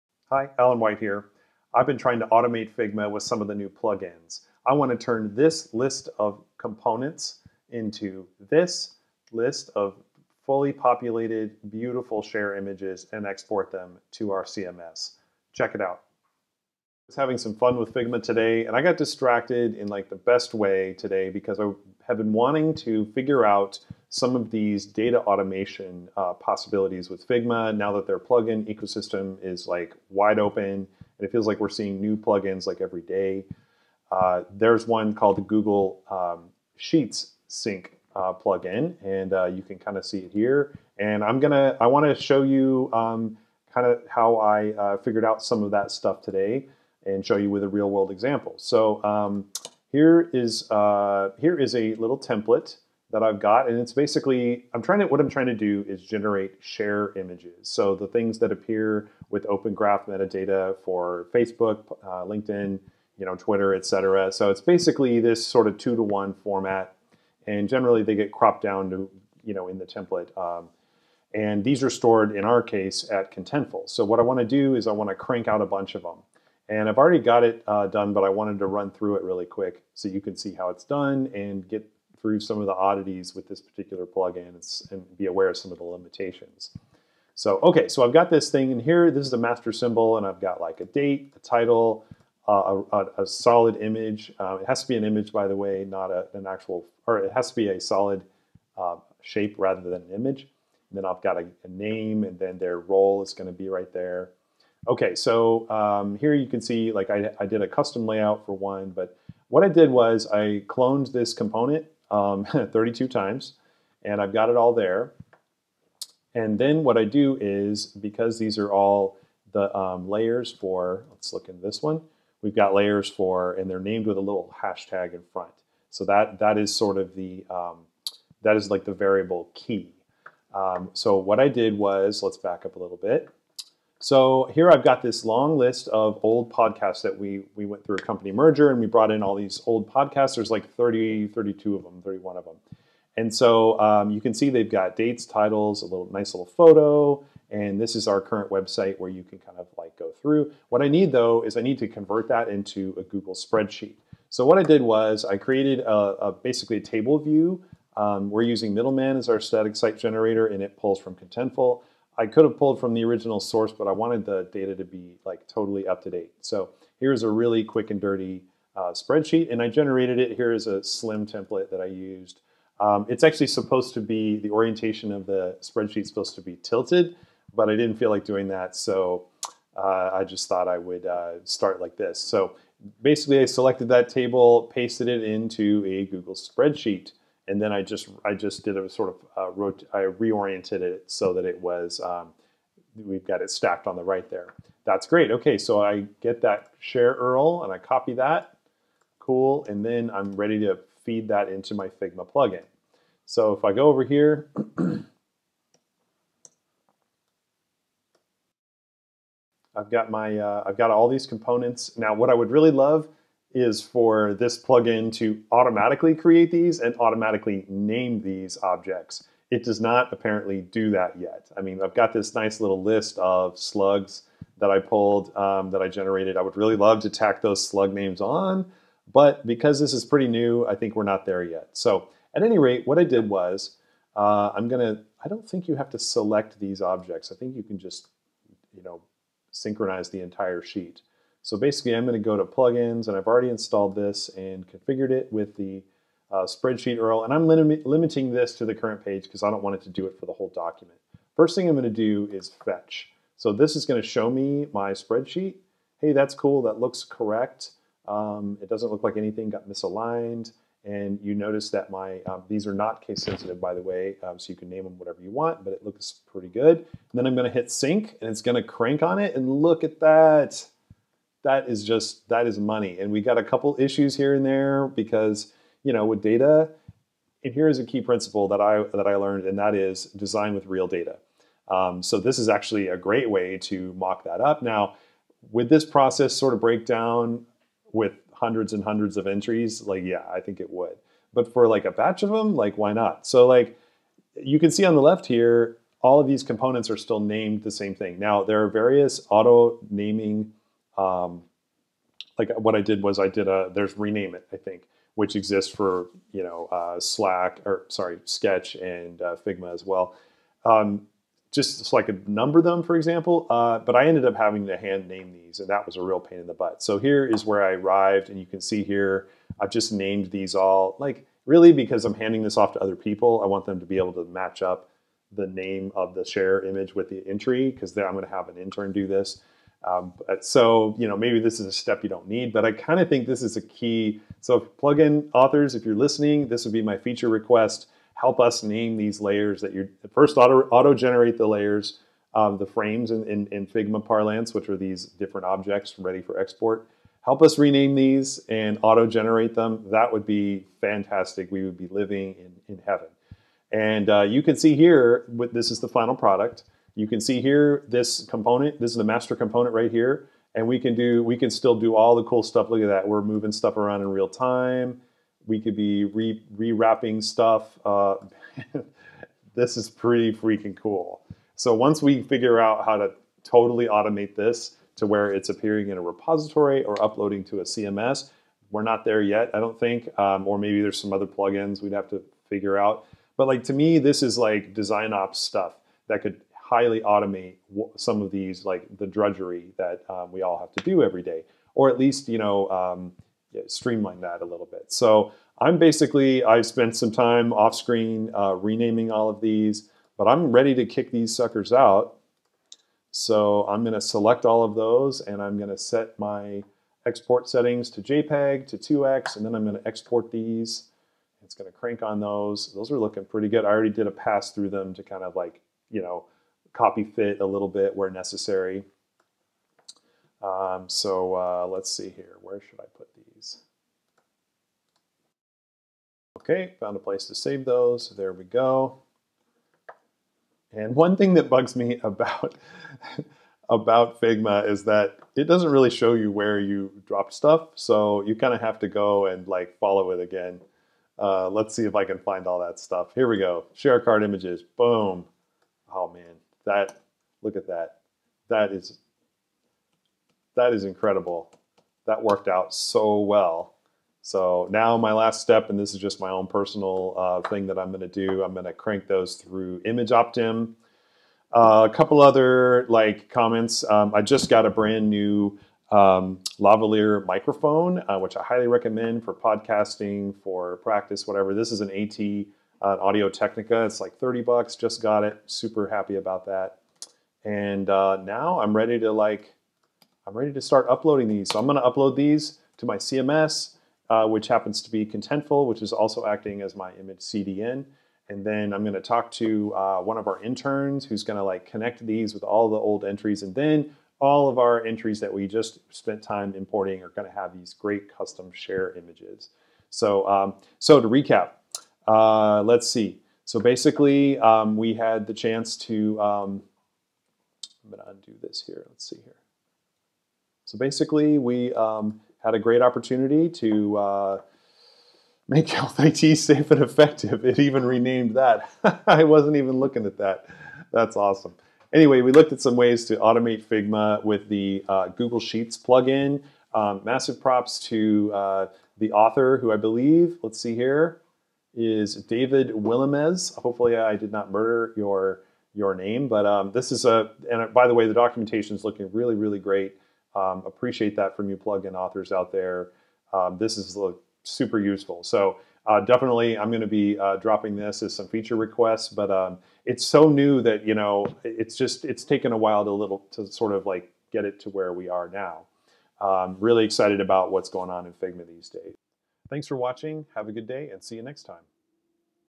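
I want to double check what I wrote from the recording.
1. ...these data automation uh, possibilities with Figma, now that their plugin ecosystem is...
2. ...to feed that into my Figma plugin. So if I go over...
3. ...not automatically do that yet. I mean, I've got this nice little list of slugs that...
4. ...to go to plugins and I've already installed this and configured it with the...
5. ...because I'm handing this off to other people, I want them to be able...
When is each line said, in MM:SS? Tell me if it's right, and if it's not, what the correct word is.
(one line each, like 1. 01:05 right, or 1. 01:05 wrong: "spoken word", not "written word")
1. 00:24 right
2. 03:20 right
3. 03:39 wrong: "apparently", not "automatically"
4. 04:02 right
5. 05:21 right.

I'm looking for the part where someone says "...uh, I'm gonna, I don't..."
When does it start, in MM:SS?
03:54.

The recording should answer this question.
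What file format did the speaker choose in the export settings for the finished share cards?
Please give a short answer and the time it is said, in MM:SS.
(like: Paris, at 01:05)
JPEG, at 06:48.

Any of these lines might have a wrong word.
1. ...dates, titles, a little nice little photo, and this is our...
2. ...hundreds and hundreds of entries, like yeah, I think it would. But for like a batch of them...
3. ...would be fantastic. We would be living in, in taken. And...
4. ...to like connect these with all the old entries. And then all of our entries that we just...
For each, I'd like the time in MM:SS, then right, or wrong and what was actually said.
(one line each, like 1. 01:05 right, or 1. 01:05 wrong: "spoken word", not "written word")
1. 02:24 right
2. 04:48 right
3. 05:50 wrong: "heaven", not "taken"
4. 08:11 right.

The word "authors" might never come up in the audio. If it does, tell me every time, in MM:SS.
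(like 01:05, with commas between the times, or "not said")
05:35, 08:49, 09:01.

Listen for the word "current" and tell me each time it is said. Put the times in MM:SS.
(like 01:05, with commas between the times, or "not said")
02:28, 04:08.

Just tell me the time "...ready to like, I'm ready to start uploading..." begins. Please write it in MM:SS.
07:58.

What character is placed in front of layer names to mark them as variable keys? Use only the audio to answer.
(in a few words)
hashtag.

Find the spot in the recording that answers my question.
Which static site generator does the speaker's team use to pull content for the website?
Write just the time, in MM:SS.
02:38.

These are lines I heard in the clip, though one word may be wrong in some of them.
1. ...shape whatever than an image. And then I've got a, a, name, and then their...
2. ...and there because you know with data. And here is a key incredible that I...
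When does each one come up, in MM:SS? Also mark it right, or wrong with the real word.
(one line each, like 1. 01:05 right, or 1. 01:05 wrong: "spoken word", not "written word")
1. 01:39 wrong: "rather", not "whatever"
2. 04:34 wrong: "principle", not "incredible".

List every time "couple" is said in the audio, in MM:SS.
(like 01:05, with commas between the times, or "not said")
04:33, 07:41.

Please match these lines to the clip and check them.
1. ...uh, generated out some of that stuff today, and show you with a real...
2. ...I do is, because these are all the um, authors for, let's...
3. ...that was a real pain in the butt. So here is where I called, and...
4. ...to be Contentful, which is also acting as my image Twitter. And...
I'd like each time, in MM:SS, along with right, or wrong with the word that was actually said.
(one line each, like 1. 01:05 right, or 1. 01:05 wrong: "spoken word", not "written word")
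1. 00:44 wrong: "figured", not "generated"
2. 01:56 wrong: "layers", not "authors"
3. 05:15 wrong: "arrived", not "called"
4. 08:04 wrong: "CDN", not "Twitter".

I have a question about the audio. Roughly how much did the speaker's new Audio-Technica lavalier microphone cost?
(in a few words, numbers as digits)
30 bucks.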